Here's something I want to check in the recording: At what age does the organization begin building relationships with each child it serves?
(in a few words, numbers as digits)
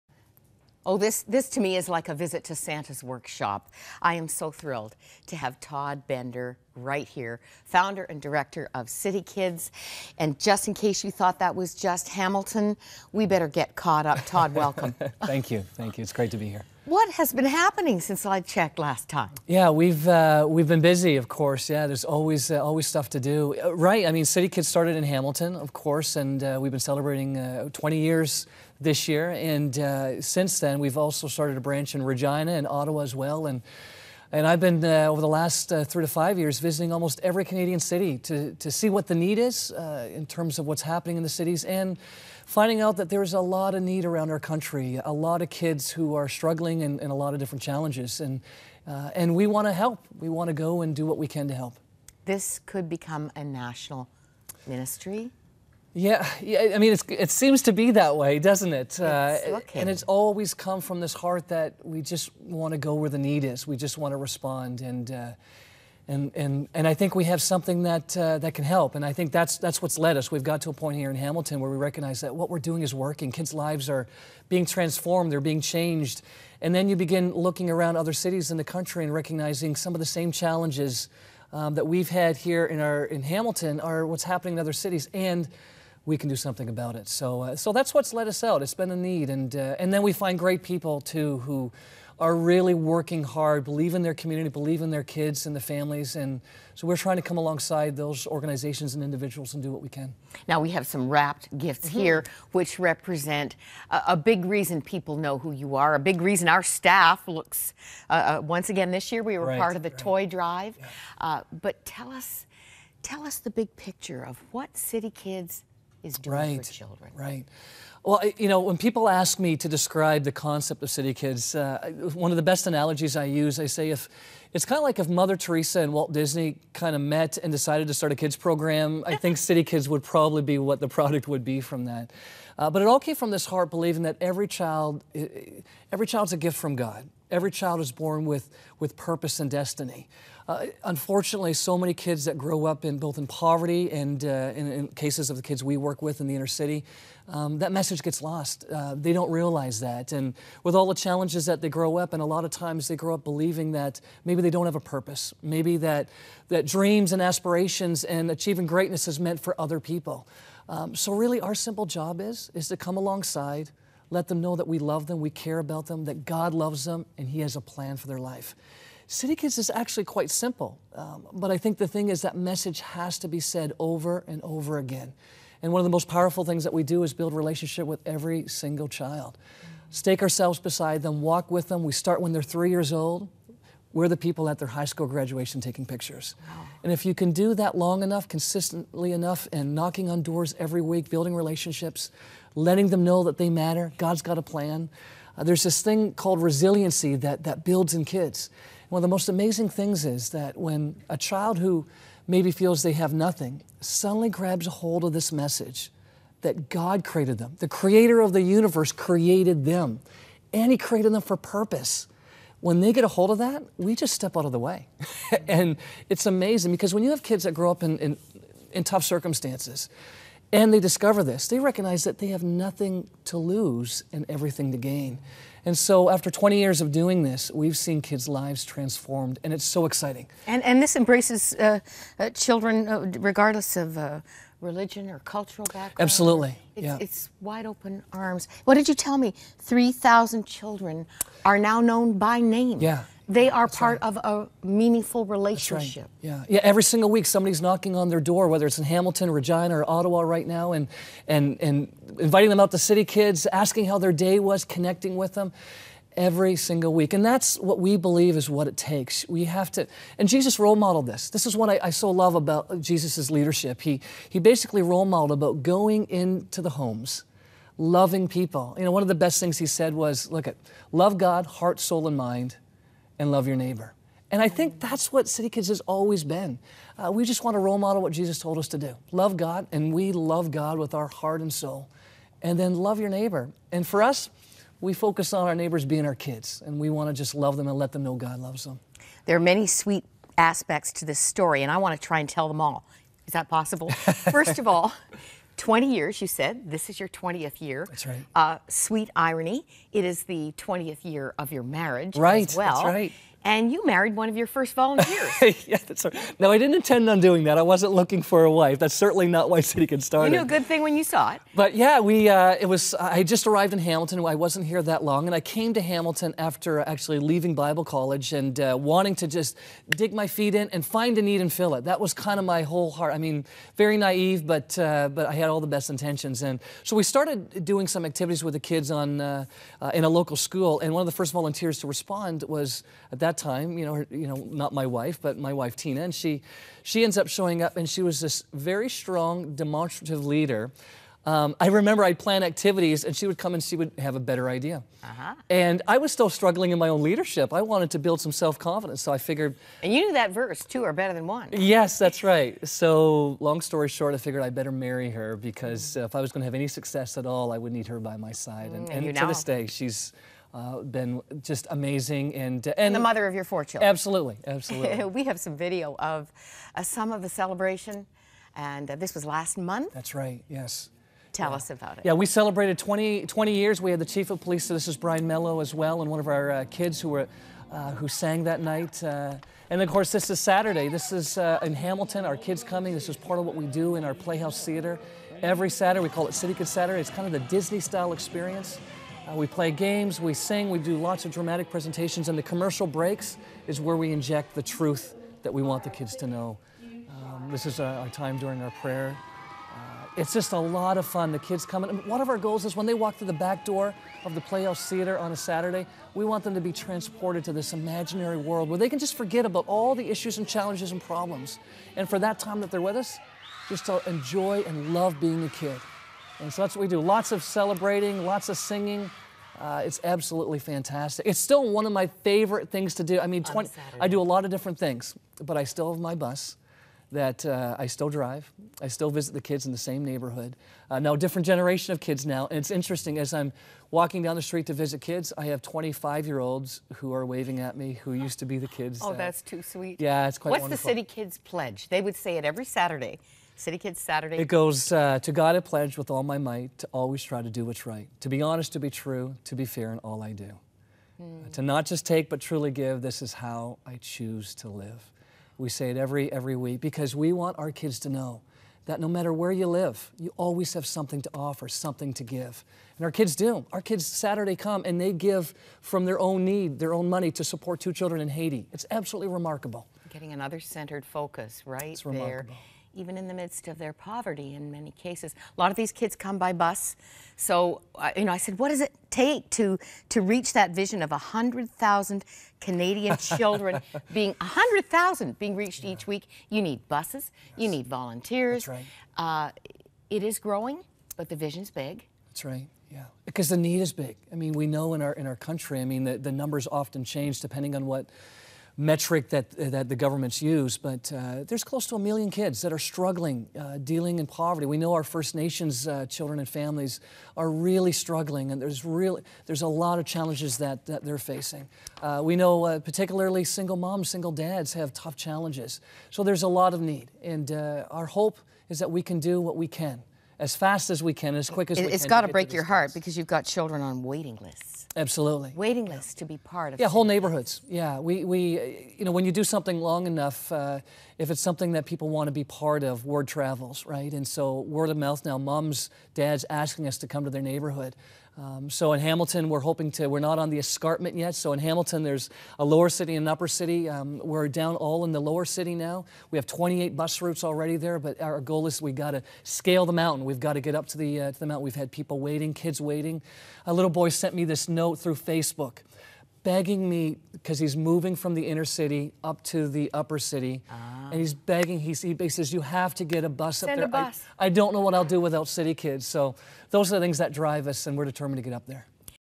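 3.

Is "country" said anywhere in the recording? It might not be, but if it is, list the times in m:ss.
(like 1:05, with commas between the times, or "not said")
0:44, 1:18, 8:15.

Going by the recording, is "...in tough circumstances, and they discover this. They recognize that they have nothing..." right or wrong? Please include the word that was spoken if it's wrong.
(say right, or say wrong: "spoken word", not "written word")
right.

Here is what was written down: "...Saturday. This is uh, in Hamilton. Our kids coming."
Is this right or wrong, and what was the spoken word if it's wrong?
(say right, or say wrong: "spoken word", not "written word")
right.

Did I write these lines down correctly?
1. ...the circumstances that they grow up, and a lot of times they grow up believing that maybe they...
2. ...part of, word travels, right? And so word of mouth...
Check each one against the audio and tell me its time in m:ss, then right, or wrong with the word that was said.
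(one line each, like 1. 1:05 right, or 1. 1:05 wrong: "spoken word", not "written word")
1. 2:30 wrong: "challenges", not "circumstances"
2. 8:52 right.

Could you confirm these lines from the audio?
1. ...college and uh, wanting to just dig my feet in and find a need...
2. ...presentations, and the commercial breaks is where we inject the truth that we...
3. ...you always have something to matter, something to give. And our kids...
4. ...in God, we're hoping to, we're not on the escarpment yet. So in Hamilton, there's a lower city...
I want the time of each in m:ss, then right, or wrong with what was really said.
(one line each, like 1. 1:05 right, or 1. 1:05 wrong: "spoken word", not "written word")
1. 5:17 right
2. 6:31 right
3. 7:40 wrong: "offer", not "matter"
4. 8:58 wrong: "Hamilton", not "God".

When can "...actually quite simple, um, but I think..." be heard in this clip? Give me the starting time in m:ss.
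2:49.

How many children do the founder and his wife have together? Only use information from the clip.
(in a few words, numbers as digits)
4.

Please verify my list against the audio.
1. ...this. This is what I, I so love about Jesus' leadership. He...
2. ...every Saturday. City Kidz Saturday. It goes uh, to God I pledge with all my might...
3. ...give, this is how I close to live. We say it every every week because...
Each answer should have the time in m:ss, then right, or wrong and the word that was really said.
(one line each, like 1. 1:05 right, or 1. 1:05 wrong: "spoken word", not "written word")
1. 4:21 right
2. 7:22 right
3. 7:32 wrong: "choose", not "close".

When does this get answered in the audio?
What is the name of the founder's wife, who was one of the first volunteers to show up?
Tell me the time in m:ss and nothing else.
5:35.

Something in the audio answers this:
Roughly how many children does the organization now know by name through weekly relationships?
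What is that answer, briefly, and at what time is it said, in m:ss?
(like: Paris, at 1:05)
3,000, at 3:59.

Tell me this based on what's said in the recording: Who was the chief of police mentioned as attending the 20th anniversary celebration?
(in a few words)
Brian Mello.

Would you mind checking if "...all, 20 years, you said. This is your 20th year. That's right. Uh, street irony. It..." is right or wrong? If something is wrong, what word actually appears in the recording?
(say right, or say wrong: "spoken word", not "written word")
wrong: "sweet", not "street".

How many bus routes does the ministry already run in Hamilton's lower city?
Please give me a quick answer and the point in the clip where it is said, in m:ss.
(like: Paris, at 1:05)
28, at 9:06.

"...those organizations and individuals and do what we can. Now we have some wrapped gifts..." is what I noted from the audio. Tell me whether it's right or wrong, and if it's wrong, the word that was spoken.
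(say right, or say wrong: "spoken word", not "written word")
right.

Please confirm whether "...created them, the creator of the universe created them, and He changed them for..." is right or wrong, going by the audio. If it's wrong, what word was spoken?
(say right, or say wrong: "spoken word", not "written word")
wrong: "created", not "changed".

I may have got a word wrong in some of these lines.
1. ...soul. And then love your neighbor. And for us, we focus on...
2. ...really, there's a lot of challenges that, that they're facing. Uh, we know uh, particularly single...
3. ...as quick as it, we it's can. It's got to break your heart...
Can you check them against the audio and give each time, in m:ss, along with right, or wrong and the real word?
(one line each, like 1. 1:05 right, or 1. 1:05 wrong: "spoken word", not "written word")
1. 4:41 right
2. 8:28 right
3. 8:41 right.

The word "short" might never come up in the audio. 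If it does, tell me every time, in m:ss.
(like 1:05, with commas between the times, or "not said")
5:53.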